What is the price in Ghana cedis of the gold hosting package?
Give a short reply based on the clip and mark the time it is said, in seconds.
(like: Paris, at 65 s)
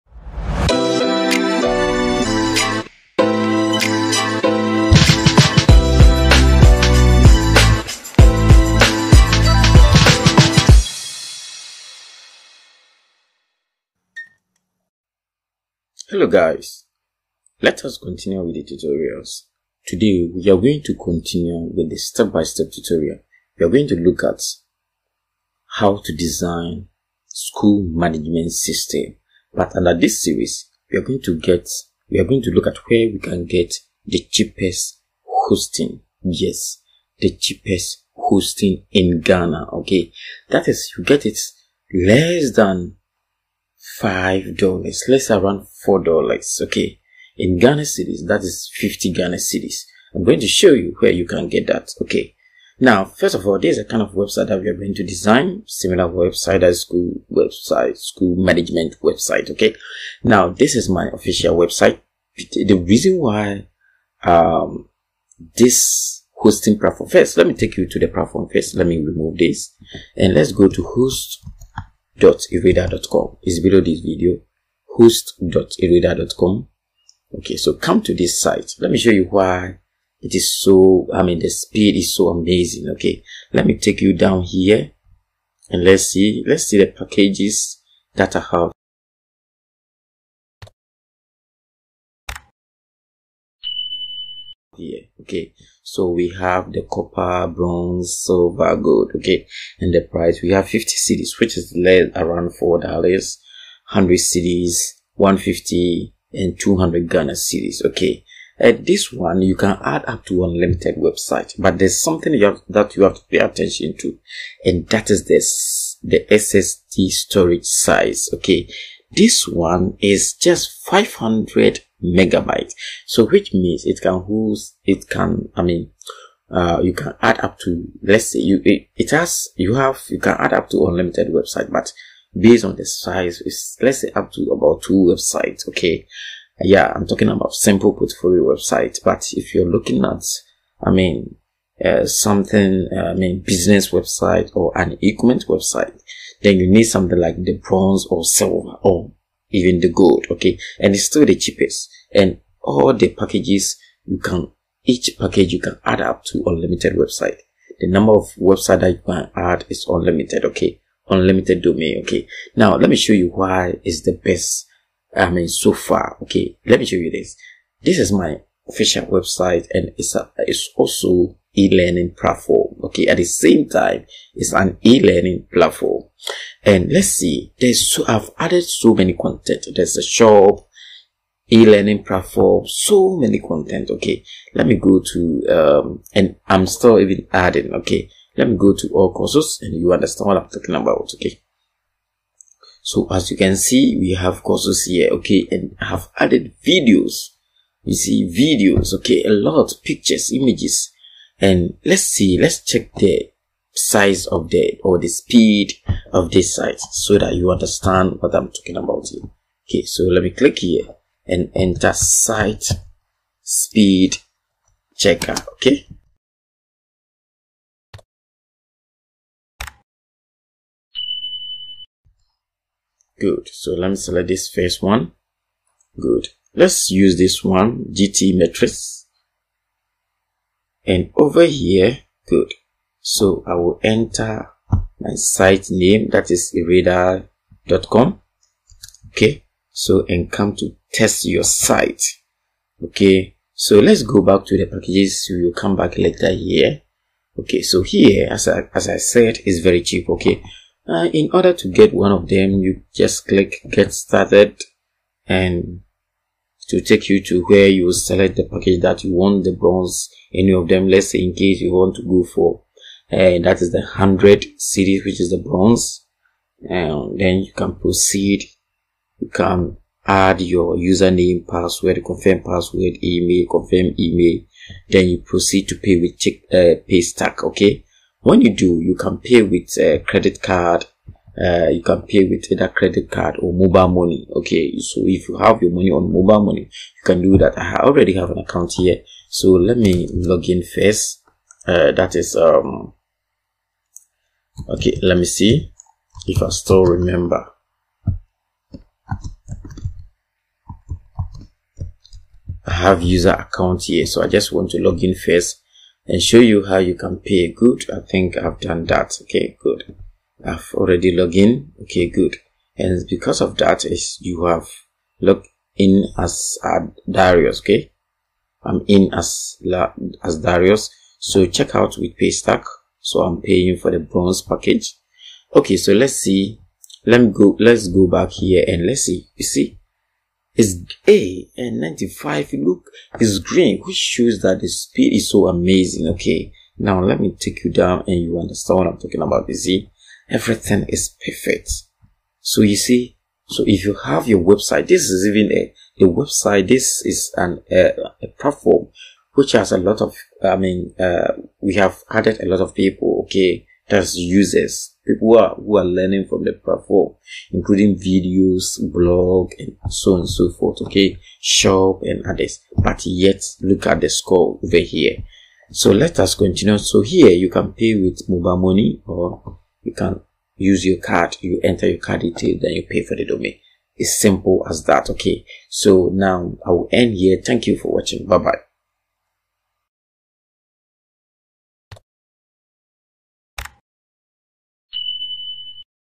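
200 cedis, at 106 s.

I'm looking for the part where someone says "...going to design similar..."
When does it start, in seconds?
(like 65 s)
54 s.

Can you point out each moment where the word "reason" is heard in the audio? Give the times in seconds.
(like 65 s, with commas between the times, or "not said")
62 s.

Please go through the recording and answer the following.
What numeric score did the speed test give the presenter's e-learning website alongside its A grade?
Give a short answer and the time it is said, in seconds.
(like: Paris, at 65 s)
95, at 331 s.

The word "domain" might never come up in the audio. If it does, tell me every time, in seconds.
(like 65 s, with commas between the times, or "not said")
161 s, 373 s.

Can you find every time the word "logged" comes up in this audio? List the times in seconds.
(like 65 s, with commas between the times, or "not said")
311 s, 315 s.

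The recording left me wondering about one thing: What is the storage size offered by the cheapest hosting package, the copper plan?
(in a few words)
500 megabytes.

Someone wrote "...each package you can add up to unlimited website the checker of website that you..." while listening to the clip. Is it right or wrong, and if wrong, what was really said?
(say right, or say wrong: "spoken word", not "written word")
wrong: "number", not "checker".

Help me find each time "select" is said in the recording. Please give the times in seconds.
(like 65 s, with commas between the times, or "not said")
223 s, 257 s.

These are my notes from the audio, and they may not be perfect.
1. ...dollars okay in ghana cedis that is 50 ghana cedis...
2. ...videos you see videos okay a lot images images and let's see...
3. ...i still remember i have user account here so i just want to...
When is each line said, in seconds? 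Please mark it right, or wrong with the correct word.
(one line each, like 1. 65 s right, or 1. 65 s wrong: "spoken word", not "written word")
1. 46 s right
2. 196 s wrong: "pictures", not "images"
3. 296 s right.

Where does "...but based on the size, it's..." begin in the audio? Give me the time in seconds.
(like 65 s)
131 s.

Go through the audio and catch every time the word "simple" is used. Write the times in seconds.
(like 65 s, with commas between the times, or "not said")
137 s, 374 s.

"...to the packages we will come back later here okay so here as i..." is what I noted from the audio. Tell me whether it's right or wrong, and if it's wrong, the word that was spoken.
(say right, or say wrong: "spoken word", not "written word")
right.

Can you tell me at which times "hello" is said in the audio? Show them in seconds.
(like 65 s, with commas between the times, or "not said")
16 s.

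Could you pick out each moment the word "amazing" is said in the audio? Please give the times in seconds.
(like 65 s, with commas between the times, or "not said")
82 s, 335 s.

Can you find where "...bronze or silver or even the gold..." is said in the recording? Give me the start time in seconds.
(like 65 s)
147 s.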